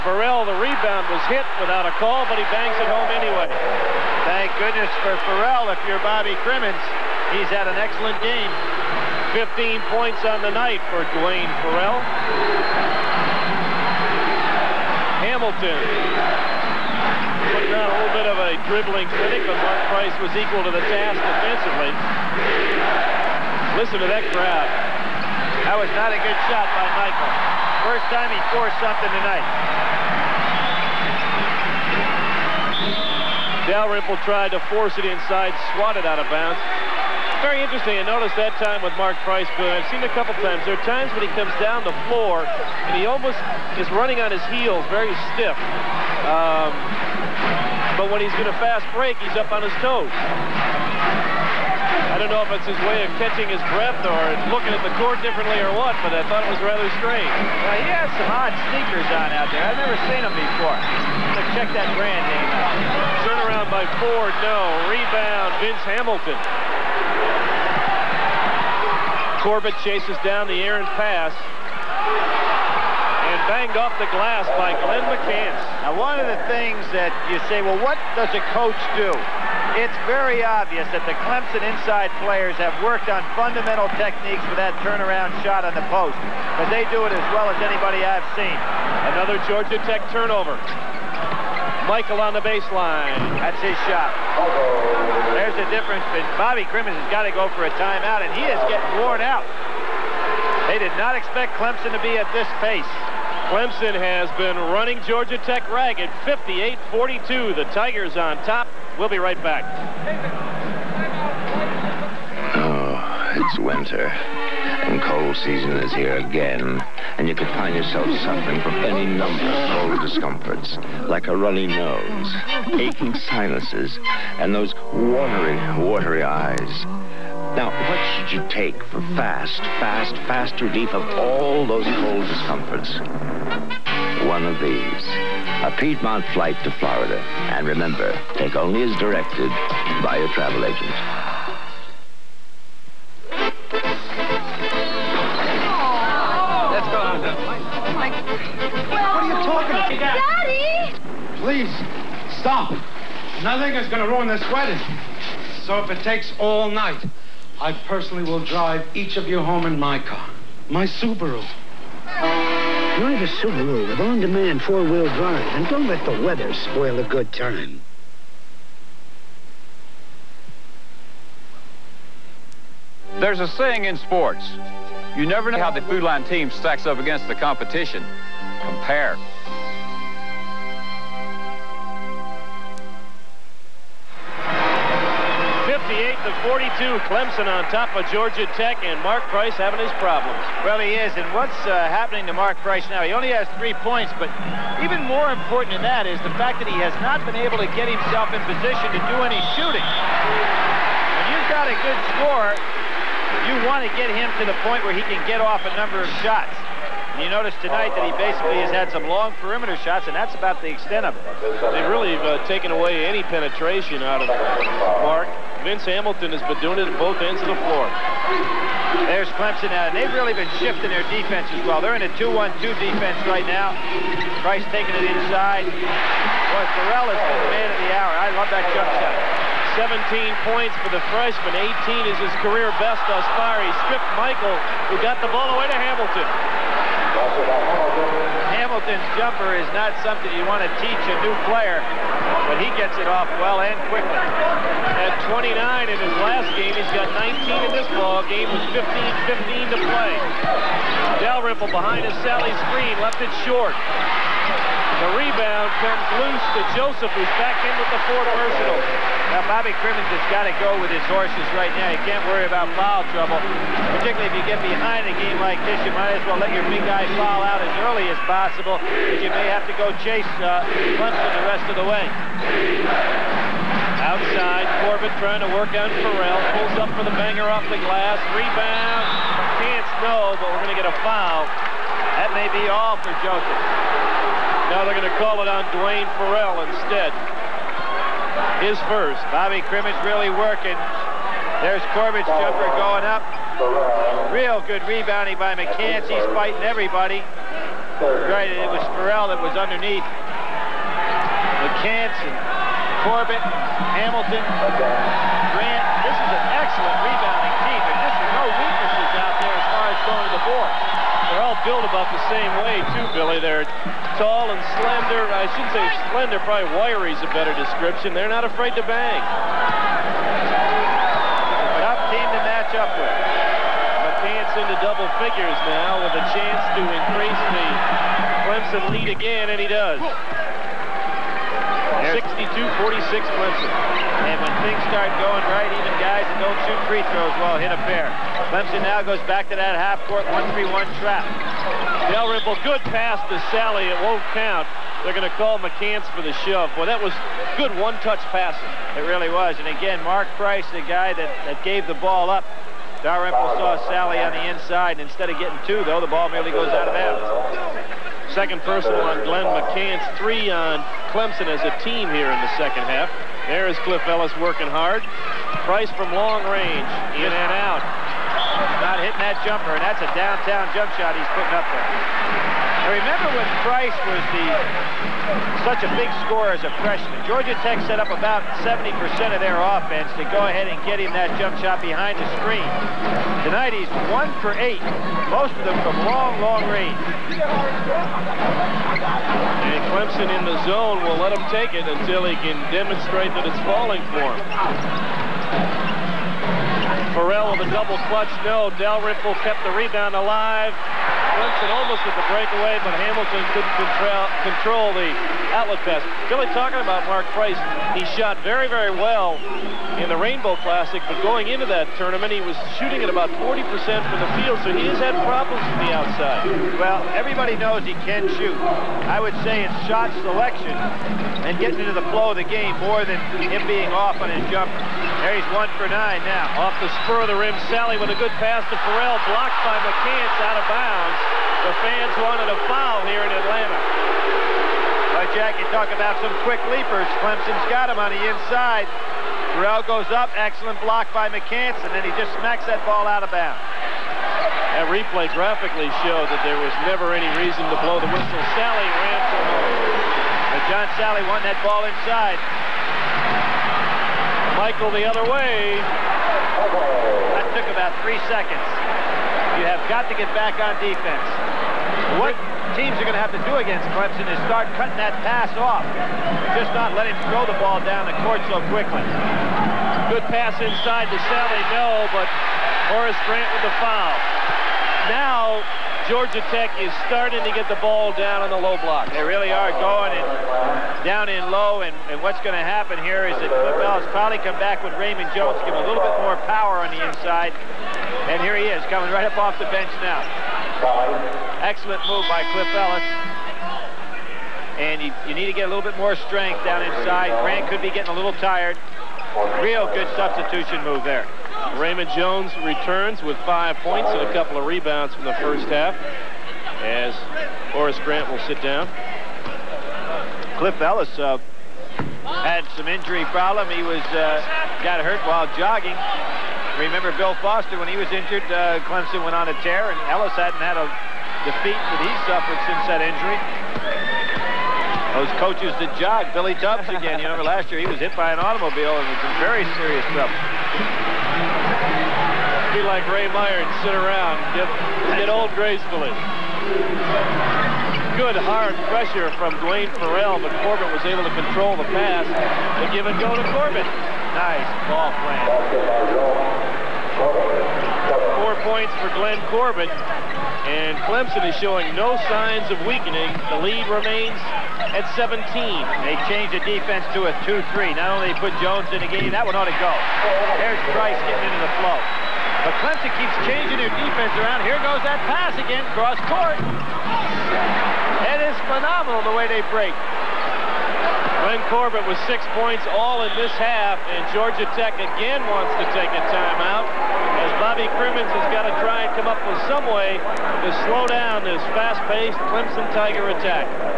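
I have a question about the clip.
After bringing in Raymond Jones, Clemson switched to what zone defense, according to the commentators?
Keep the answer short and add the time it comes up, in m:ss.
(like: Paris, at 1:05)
2-3, at 9:17.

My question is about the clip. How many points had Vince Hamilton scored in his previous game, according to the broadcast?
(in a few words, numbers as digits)
29.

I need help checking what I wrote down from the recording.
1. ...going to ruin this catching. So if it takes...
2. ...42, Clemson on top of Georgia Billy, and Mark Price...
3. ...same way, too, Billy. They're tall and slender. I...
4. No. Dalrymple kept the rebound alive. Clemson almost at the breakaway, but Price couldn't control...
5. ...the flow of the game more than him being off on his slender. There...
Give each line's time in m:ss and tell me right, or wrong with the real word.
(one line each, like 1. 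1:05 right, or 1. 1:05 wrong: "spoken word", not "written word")
1. 2:33 wrong: "wedding", not "catching"
2. 3:06 wrong: "Tech", not "Billy"
3. 5:12 right
4. 6:38 wrong: "Hamilton", not "Price"
5. 7:01 wrong: "jumper", not "slender".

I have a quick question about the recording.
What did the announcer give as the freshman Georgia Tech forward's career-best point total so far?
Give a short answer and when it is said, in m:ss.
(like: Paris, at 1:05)
18, at 3:51.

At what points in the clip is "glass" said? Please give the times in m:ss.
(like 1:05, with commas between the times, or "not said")
1:14, 4:37.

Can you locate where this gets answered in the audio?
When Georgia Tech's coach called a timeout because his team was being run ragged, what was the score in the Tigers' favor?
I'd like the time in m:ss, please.
1:46.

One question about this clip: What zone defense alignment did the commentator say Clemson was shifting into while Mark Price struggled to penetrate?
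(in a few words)
2-1-2.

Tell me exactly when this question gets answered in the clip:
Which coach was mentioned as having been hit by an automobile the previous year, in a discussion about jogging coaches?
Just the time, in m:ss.
8:46.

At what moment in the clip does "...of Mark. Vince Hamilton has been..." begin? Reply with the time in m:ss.
3:34.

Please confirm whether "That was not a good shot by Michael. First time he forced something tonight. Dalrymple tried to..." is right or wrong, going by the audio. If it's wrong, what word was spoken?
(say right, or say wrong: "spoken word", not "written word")
right.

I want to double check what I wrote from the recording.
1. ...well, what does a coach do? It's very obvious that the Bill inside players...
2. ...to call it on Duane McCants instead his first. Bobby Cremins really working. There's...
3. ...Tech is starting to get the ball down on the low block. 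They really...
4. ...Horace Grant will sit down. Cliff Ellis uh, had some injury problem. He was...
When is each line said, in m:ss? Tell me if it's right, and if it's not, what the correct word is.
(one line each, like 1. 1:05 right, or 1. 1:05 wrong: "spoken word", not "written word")
1. 1:17 wrong: "Clemson", not "Bill"
2. 4:45 wrong: "Ferrell", not "McCants"
3. 7:56 right
4. 8:27 right.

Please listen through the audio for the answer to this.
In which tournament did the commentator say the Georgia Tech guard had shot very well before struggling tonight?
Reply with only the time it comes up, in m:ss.
6:50.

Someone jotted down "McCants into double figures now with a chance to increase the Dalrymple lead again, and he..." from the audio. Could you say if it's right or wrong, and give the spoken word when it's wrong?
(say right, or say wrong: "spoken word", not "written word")
wrong: "Clemson", not "Dalrymple".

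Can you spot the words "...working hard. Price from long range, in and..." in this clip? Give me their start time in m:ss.
6:04.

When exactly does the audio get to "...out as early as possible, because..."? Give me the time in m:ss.
4:27.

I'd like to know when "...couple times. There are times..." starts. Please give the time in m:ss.
0:40.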